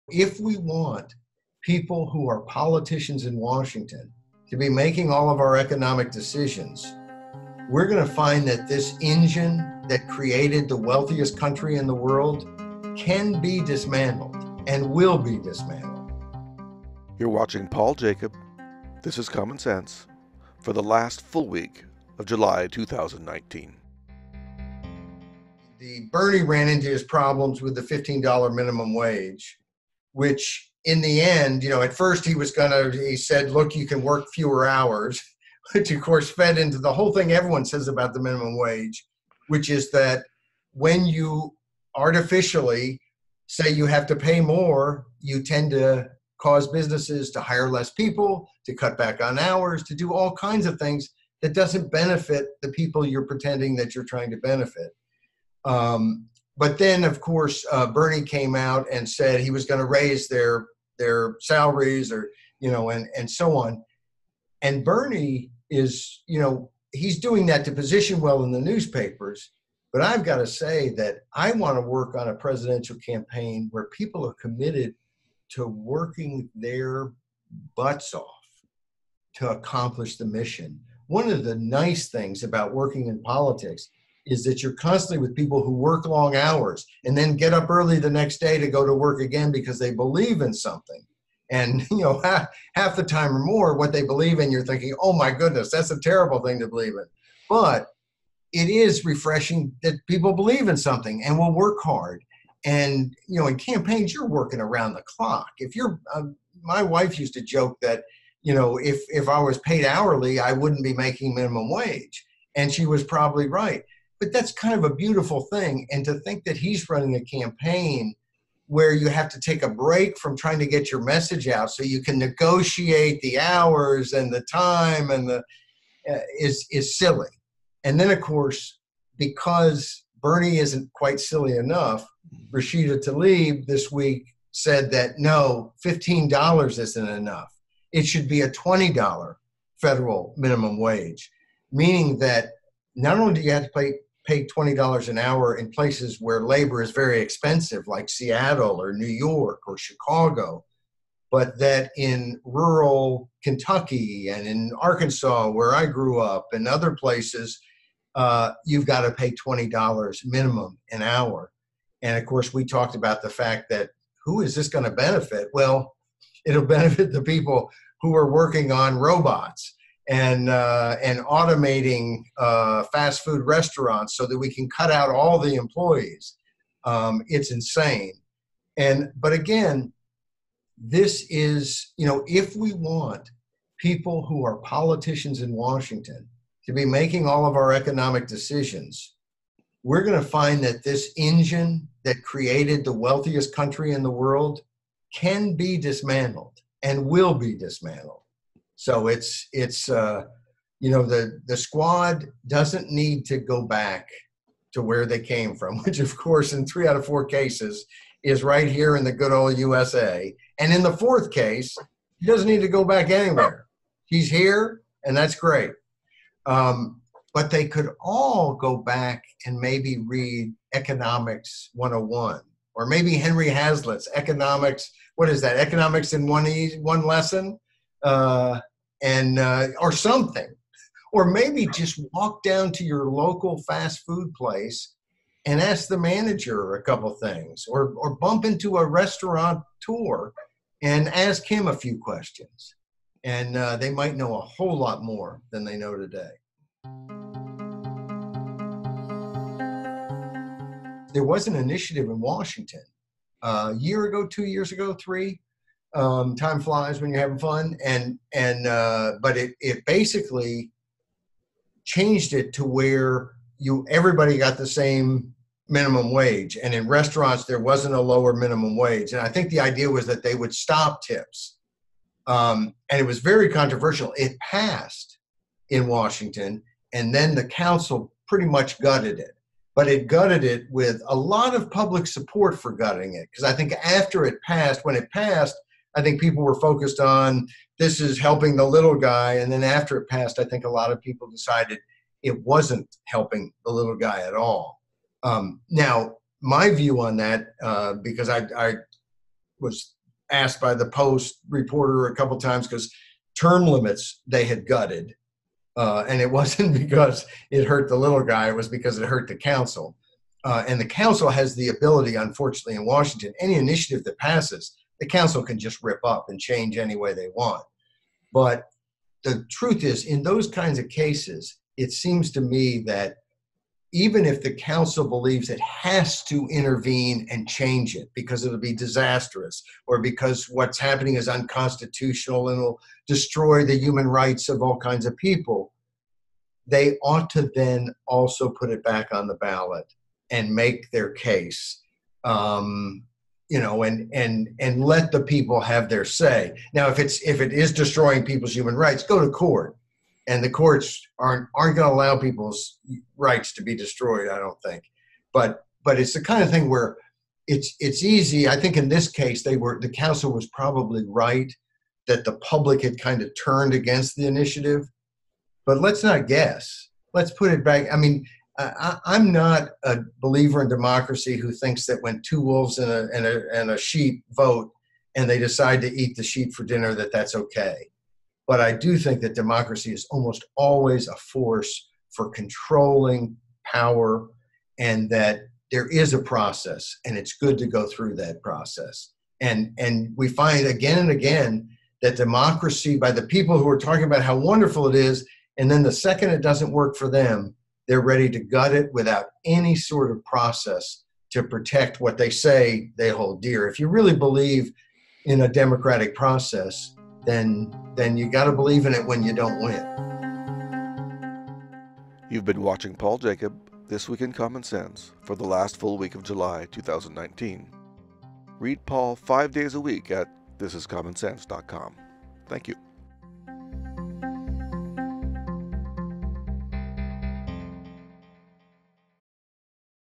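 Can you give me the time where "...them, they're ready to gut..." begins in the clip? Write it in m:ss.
6:37.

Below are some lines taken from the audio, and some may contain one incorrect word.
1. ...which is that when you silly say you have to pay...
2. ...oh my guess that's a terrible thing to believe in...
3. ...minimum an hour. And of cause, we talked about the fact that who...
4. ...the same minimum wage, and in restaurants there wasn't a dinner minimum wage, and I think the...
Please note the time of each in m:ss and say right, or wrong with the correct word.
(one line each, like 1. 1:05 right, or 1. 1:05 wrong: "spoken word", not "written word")
1. 0:39 wrong: "artificially", not "silly"
2. 1:35 wrong: "goodness", not "guess"
3. 2:40 wrong: "course", not "cause"
4. 4:24 wrong: "lower", not "dinner".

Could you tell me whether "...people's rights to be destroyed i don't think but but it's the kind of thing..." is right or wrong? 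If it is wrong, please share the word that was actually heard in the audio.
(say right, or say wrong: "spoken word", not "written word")
right.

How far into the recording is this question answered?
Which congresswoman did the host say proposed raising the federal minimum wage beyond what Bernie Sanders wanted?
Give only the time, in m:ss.
2:12.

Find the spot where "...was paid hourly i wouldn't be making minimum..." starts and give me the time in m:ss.
1:49.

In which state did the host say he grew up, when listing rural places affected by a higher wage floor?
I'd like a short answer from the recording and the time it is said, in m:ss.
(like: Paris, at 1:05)
Arkansas, at 2:34.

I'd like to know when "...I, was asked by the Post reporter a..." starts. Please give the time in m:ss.
4:58.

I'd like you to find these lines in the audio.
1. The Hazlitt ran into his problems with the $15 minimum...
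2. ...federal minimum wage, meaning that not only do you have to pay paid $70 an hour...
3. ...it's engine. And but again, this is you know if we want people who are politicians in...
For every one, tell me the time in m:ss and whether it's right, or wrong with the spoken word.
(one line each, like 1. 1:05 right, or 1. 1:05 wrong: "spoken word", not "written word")
1. 0:25 wrong: "Bernie", not "Hazlitt"
2. 2:19 wrong: "20", not "70"
3. 2:57 wrong: "insane", not "engine".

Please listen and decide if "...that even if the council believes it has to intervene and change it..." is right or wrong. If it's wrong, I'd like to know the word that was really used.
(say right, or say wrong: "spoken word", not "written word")
right.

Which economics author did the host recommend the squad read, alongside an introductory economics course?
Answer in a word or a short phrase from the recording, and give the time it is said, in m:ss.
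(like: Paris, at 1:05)
Henry Hazlitt, at 3:43.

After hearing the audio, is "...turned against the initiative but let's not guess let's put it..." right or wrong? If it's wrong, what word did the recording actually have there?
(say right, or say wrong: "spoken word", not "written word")
right.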